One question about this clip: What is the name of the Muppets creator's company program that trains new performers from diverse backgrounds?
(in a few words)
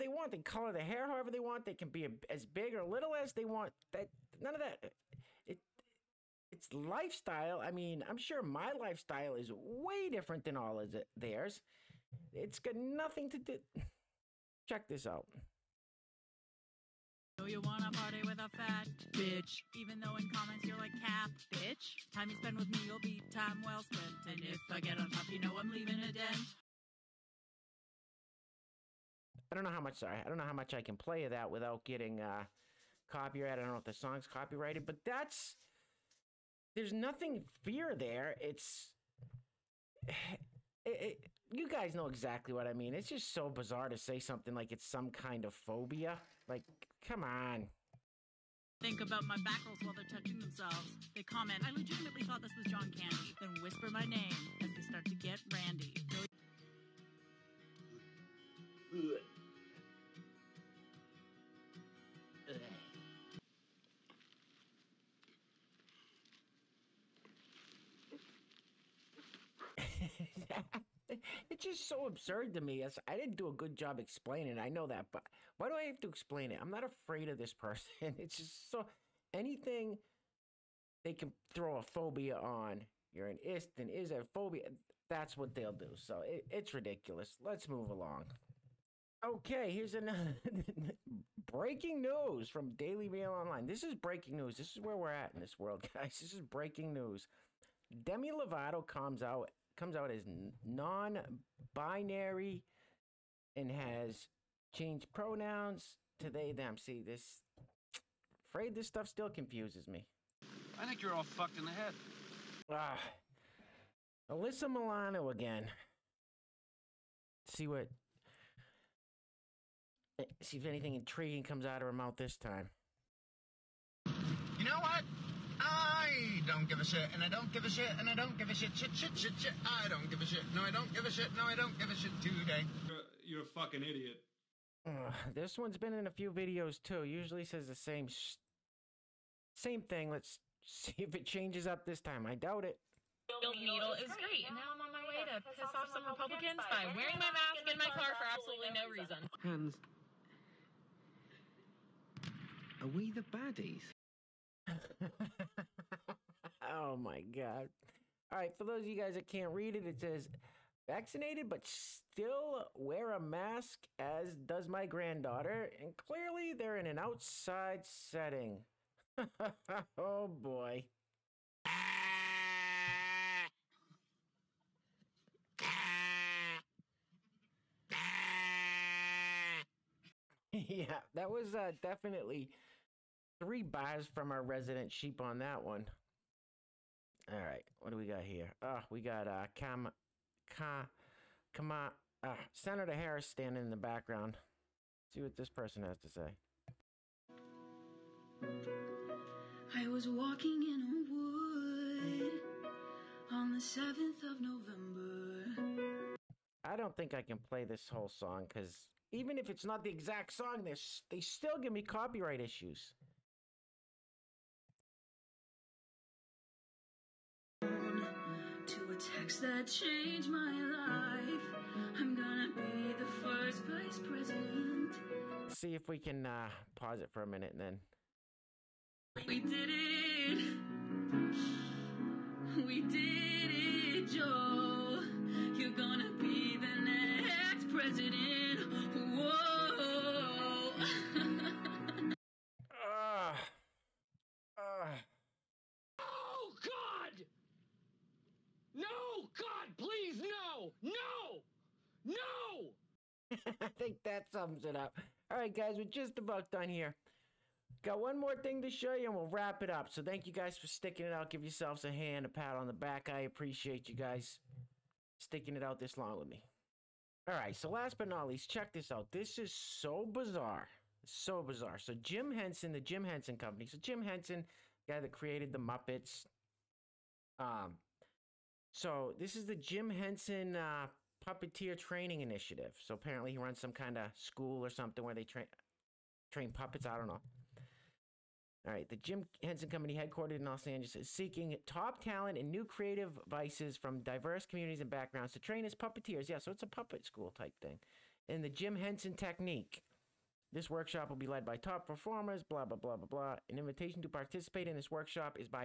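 Puppeteer Training Initiative.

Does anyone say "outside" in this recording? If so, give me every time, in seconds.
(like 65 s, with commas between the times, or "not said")
166 s.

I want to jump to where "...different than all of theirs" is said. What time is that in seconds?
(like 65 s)
10 s.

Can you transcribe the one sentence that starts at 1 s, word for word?
They can be a, as big or little as they want.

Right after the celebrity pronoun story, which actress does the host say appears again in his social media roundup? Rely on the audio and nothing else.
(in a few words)
Alyssa Milano.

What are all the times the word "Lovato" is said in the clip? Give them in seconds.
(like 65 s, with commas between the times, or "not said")
98 s.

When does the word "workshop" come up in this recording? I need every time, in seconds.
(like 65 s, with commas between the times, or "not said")
300 s, 304 s.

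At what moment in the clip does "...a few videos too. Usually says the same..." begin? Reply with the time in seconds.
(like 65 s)
136 s.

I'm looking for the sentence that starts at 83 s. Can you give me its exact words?
You're an ist and is a phobia.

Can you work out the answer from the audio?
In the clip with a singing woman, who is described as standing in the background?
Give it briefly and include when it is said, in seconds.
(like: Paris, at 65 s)
Senator Harris, at 192 s.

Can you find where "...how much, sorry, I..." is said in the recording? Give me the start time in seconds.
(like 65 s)
29 s.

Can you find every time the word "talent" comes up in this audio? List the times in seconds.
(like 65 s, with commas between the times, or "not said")
292 s.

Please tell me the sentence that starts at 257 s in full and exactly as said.
Got one more thing to show you, and we'll wrap it up.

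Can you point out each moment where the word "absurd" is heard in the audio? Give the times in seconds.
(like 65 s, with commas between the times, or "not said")
72 s.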